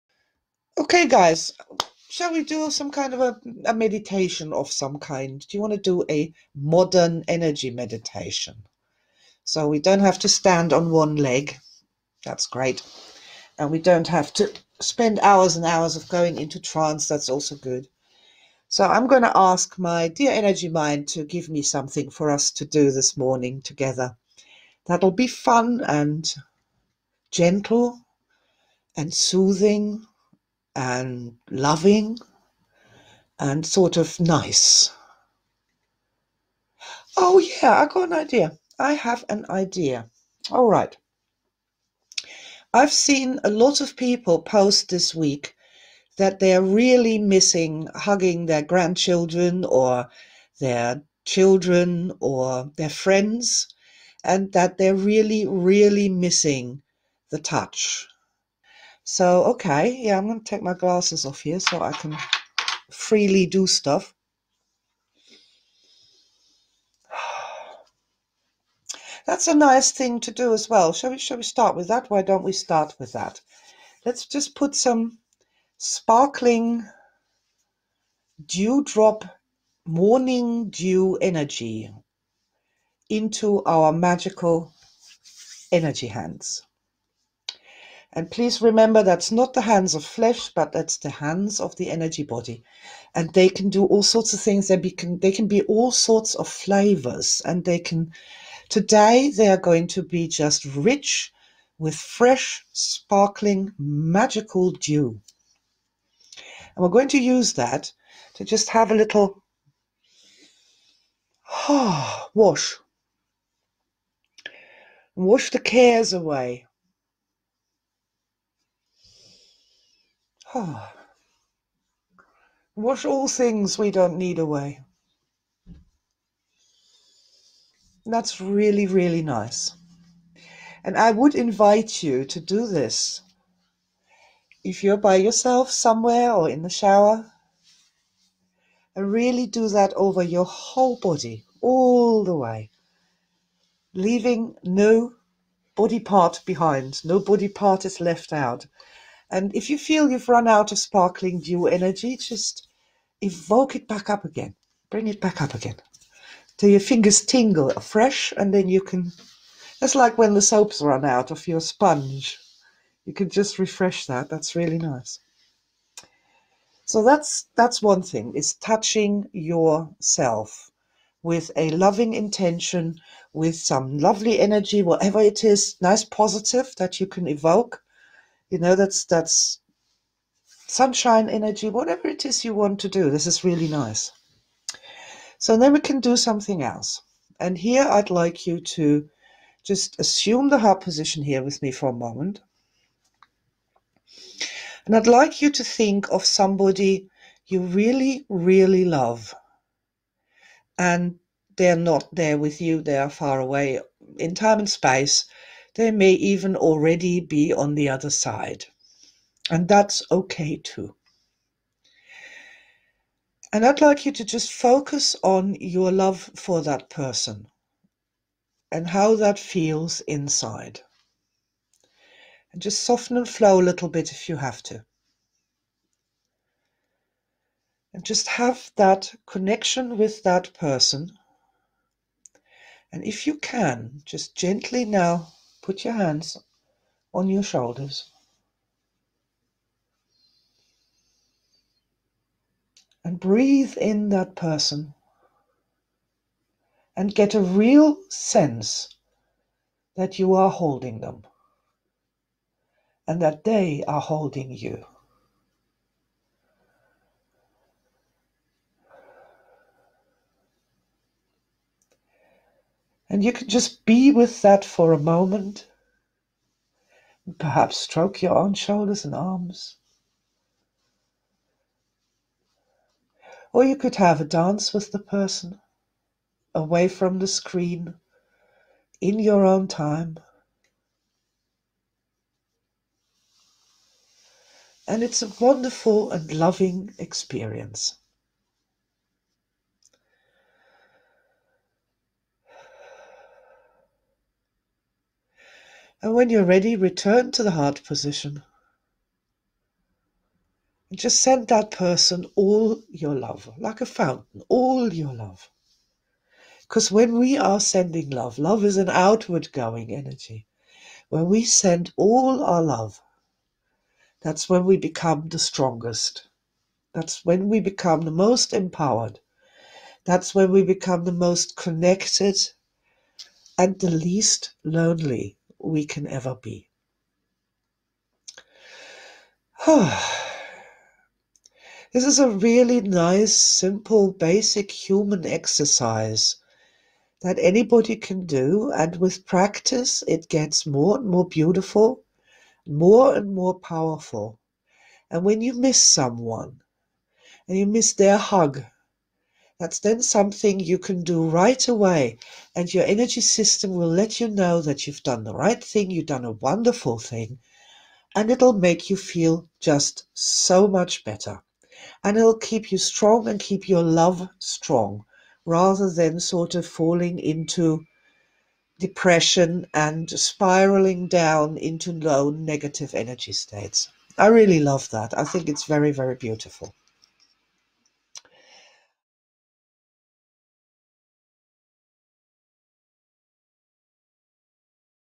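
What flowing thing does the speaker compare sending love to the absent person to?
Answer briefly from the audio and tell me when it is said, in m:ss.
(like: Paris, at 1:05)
a fountain, at 5:03.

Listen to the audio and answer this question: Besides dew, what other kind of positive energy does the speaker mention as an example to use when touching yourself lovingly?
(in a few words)
sunshine energy.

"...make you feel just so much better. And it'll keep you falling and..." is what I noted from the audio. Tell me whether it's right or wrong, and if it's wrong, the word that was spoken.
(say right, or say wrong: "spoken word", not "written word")
wrong: "strong", not "falling".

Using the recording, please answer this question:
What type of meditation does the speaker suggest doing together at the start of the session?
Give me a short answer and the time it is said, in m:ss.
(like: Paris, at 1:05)
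modern energy meditation, at 0:06.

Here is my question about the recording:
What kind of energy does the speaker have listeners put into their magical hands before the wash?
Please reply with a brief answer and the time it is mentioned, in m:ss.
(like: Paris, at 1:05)
sparkling dewdrop morning dew energy, at 1:15.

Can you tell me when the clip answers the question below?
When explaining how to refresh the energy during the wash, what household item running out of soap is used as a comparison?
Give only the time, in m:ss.
2:41.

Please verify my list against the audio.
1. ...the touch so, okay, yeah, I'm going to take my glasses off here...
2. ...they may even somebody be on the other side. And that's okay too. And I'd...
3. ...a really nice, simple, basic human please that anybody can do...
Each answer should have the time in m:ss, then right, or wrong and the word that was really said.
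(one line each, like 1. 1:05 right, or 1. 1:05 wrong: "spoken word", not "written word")
1. 0:57 right
2. 3:25 wrong: "already", not "somebody"
3. 5:32 wrong: "exercise", not "please".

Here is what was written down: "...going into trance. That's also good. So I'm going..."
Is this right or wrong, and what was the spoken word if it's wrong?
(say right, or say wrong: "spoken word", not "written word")
right.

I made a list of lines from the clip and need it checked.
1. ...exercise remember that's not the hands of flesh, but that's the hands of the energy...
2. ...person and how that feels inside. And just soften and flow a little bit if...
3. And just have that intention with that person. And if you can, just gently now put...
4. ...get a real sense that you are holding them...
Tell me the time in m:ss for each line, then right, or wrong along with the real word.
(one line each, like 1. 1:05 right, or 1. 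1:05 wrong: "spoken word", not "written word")
1. 1:28 wrong: "please", not "exercise"
2. 3:36 right
3. 3:47 wrong: "connection", not "intention"
4. 4:07 right.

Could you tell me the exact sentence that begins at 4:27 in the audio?
Perhaps stroke your own shoulders and arms.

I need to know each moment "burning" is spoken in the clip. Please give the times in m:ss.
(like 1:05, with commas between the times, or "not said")
not said.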